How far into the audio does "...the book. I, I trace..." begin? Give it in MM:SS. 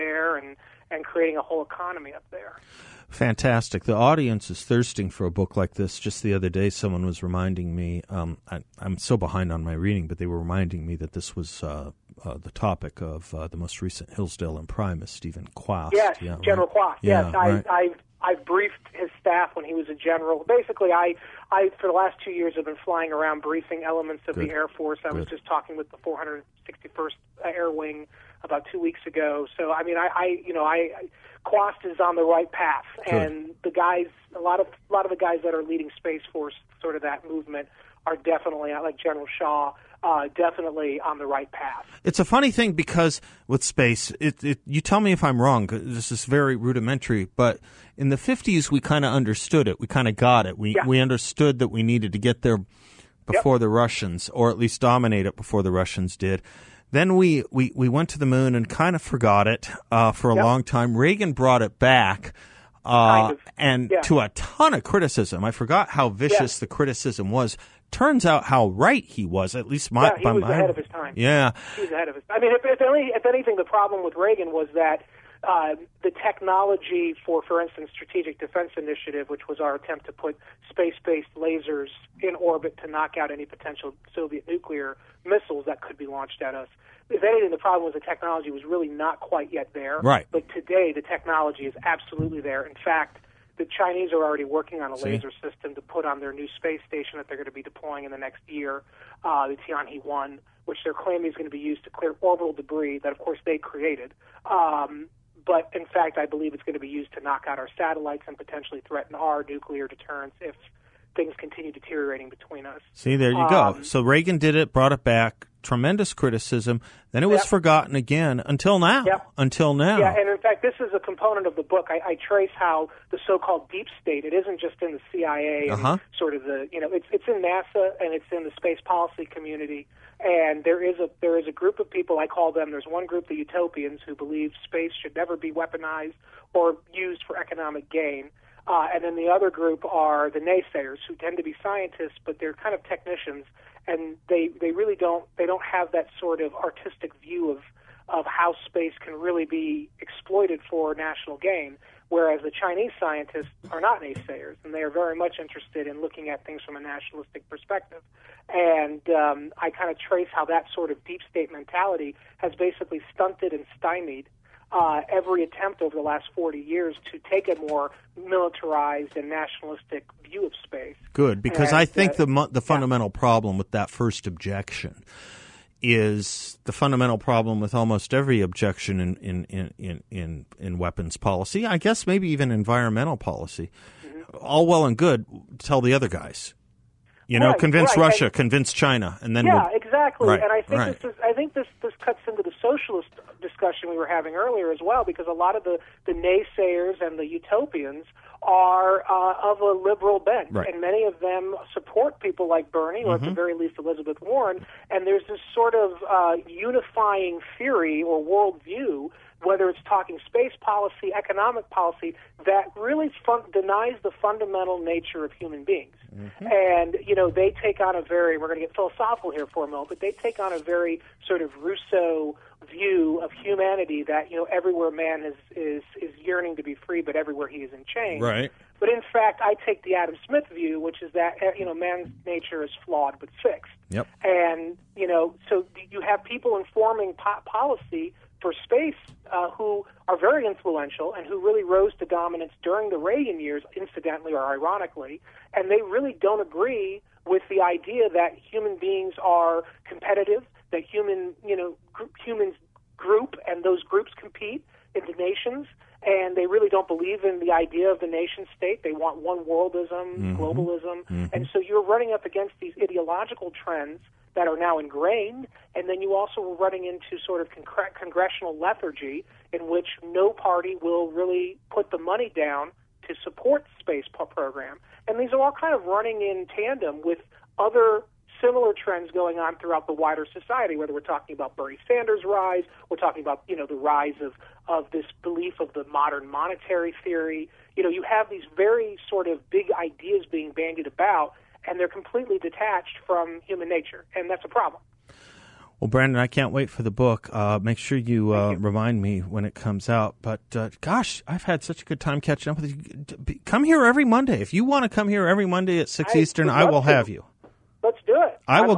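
02:01.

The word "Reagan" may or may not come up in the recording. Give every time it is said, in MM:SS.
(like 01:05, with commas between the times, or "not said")
01:00, 01:14, 01:54, 04:02.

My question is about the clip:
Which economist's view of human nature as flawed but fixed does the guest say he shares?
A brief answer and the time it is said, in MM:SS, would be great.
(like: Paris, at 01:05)
Adam Smith, at 03:49.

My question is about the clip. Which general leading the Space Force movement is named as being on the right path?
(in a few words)
General Shaw.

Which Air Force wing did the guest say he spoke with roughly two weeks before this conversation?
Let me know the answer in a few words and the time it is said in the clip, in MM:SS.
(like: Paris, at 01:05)
461st Air Wing, at 00:25.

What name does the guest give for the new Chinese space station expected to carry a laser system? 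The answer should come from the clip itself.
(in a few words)
Tianhe 1.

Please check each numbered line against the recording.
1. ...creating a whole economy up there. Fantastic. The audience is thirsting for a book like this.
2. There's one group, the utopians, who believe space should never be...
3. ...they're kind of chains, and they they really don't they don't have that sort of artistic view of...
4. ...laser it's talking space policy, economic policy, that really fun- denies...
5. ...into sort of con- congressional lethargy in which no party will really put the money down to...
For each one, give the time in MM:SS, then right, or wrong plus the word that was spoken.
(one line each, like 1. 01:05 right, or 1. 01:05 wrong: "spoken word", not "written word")
1. 00:01 right
2. 02:12 right
3. 02:22 wrong: "technicians", not "chains"
4. 03:29 wrong: "whether", not "laser"
5. 04:26 right.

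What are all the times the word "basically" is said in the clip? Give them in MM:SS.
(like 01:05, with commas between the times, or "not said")
00:20, 02:42.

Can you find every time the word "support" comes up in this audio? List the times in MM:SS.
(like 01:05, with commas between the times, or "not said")
03:21, 04:33.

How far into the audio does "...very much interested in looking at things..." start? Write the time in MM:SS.
02:34.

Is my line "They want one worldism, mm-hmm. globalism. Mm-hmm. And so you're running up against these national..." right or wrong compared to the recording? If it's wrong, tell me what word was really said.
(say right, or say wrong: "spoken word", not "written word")
wrong: "ideological", not "national".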